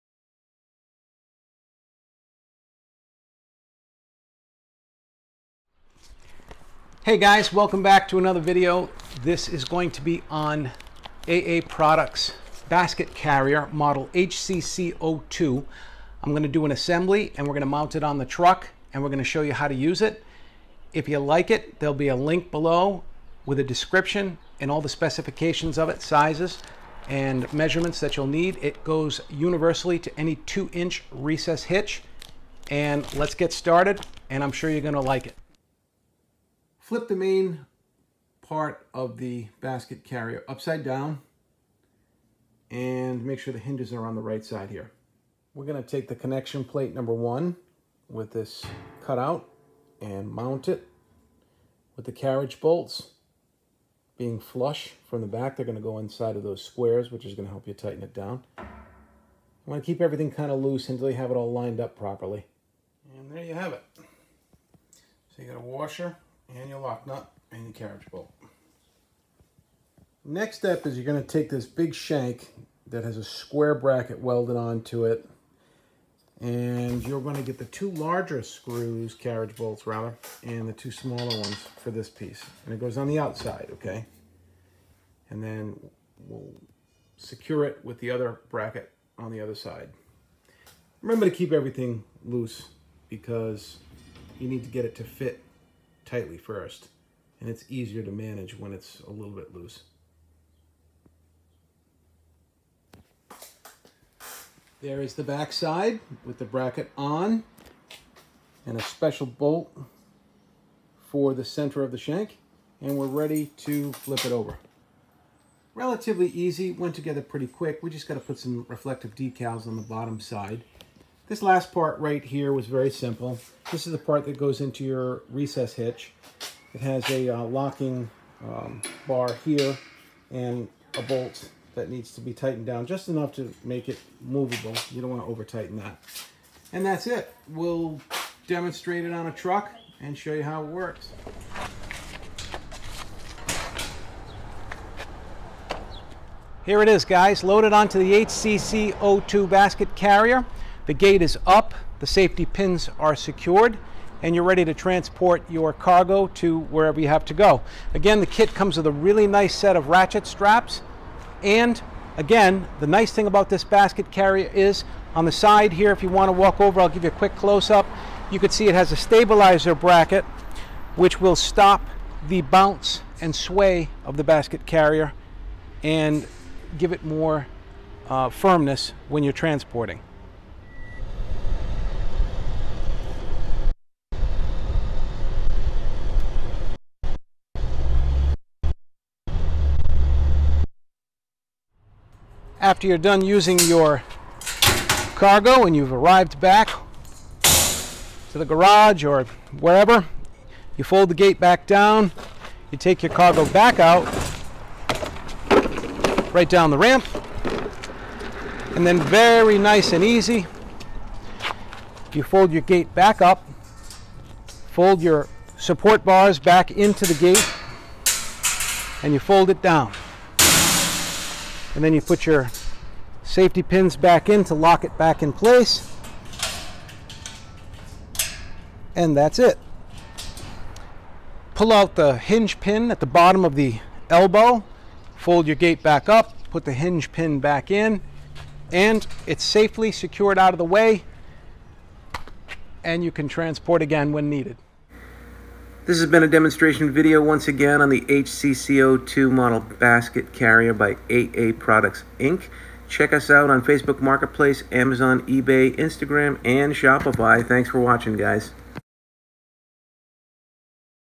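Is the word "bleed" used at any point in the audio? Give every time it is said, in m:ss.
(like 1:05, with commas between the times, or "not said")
not said.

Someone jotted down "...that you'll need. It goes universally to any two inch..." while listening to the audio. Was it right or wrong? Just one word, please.
right.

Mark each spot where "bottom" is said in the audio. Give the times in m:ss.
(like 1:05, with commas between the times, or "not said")
1:59, 3:53.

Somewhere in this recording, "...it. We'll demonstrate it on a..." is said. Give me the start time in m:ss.
2:17.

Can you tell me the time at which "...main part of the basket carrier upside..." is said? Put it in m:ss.
0:37.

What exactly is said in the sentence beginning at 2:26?
Here it is guys, loaded onto the HCC02 0 basket carrier.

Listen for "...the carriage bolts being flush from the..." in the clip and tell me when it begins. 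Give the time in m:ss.
0:52.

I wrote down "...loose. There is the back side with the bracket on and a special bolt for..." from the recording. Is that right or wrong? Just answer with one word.
right.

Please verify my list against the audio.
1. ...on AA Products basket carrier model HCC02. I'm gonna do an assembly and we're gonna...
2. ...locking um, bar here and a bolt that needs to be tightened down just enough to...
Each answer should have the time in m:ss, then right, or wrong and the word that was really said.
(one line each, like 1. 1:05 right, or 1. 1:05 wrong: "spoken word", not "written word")
1. 0:10 right
2. 2:07 right.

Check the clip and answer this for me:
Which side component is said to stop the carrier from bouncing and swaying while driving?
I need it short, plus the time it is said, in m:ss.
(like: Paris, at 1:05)
stabilizer bracket, at 2:48.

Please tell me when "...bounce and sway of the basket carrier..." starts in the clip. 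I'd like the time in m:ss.
2:52.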